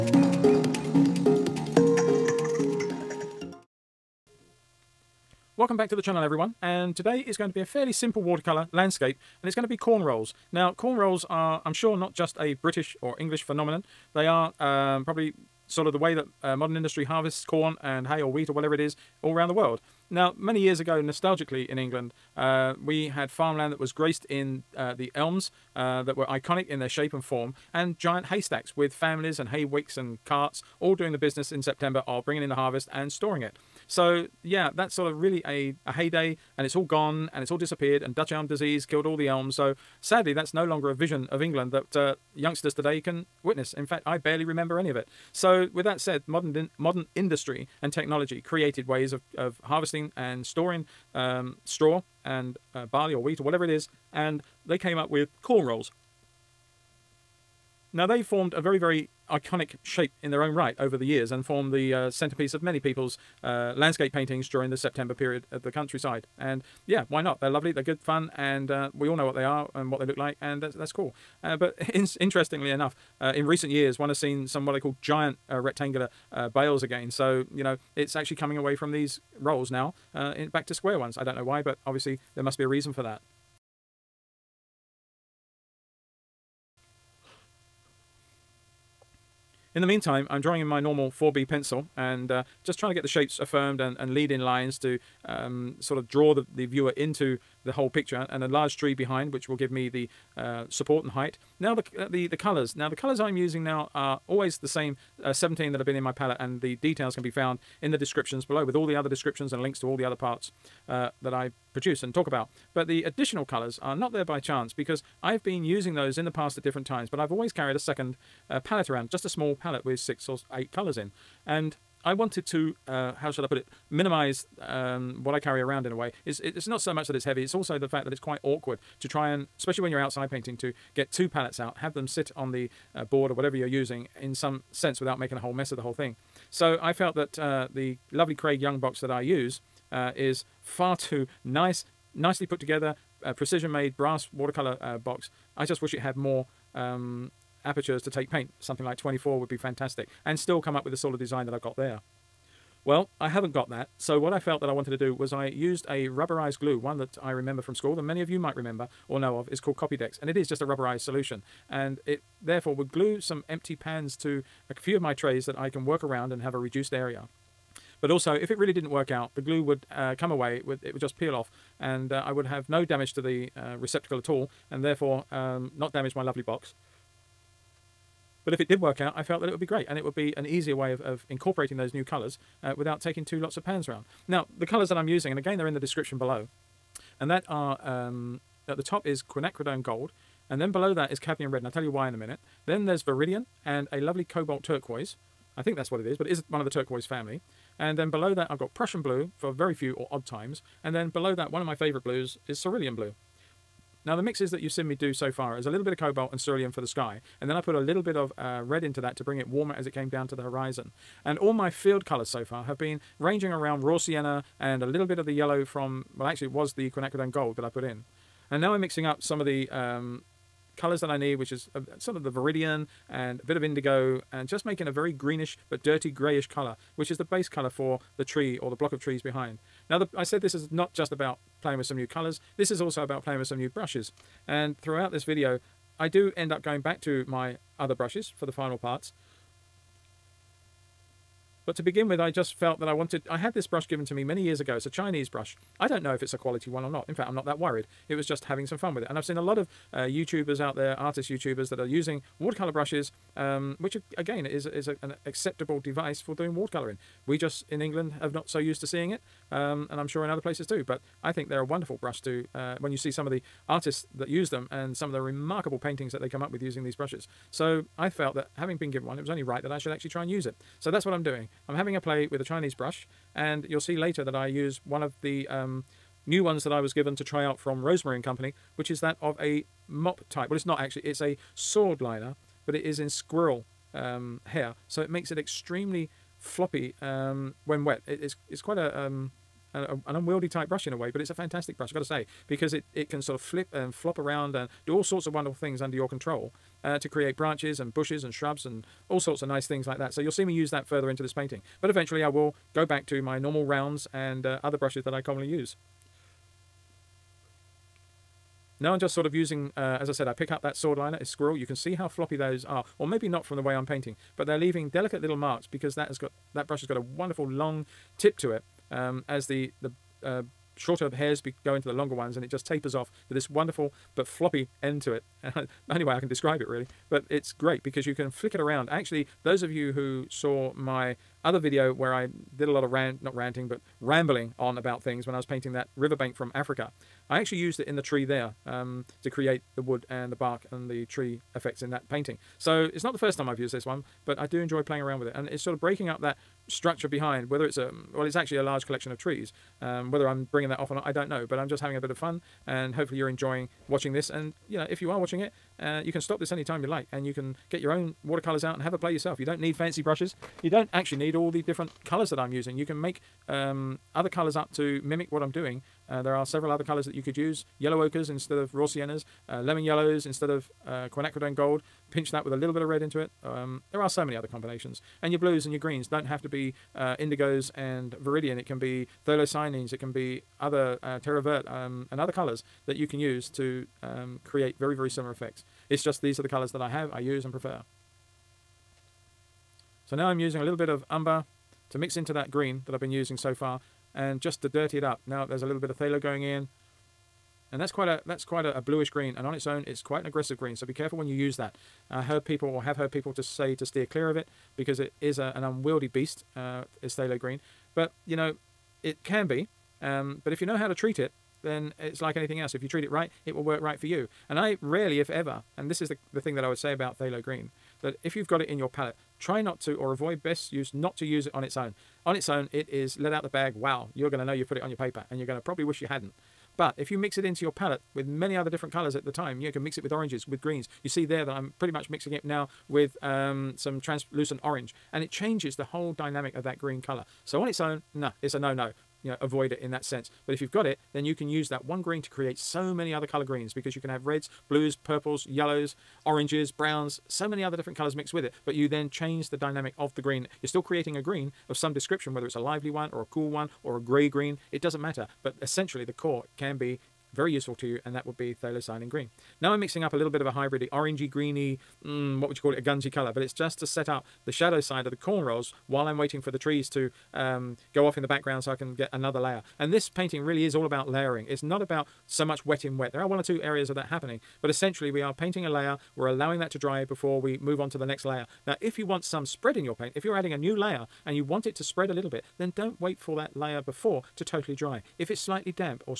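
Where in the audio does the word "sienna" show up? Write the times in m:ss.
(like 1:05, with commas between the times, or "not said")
3:33, 6:08.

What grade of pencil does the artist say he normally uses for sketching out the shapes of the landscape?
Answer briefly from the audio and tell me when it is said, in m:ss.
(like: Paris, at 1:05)
4B, at 1:31.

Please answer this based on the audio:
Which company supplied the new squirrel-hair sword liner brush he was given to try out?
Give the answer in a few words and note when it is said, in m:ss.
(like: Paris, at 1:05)
Rosemary and Company, at 4:37.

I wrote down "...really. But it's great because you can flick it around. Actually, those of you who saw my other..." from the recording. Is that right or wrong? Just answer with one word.
right.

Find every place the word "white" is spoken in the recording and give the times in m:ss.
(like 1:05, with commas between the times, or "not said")
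not said.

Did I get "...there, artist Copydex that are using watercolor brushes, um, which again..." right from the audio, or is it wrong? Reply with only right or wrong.
wrong.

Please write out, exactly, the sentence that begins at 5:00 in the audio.
So you'll see me use that further into this painting.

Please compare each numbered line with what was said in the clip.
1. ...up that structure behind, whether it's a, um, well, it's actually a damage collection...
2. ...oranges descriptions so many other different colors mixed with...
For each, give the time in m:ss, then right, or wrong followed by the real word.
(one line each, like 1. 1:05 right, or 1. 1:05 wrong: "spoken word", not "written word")
1. 5:46 wrong: "large", not "damage"
2. 7:26 wrong: "browns", not "descriptions".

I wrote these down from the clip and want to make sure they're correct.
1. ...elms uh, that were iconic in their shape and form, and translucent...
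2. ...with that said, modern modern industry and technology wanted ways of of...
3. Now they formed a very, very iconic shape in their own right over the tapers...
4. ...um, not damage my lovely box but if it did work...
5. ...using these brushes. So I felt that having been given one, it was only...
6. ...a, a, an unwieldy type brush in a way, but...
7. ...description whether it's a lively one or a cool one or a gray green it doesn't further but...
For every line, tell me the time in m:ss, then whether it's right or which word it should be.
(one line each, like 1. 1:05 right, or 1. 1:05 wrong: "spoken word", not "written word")
1. 0:25 wrong: "giant", not "translucent"
2. 0:45 wrong: "created", not "wanted"
3. 0:57 wrong: "years", not "tapers"
4. 2:55 right
5. 4:26 right
6. 4:49 right
7. 7:31 wrong: "matter", not "further".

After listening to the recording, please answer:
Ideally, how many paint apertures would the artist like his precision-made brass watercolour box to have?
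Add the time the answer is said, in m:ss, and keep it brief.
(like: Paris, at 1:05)
24, at 2:28.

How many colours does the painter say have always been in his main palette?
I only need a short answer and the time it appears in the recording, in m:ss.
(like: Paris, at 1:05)
17, at 1:45.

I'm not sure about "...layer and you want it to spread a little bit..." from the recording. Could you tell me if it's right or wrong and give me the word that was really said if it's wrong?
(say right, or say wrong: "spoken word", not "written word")
right.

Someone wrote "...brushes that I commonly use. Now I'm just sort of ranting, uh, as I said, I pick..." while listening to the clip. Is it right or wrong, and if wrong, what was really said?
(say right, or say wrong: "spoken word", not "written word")
wrong: "using", not "ranting".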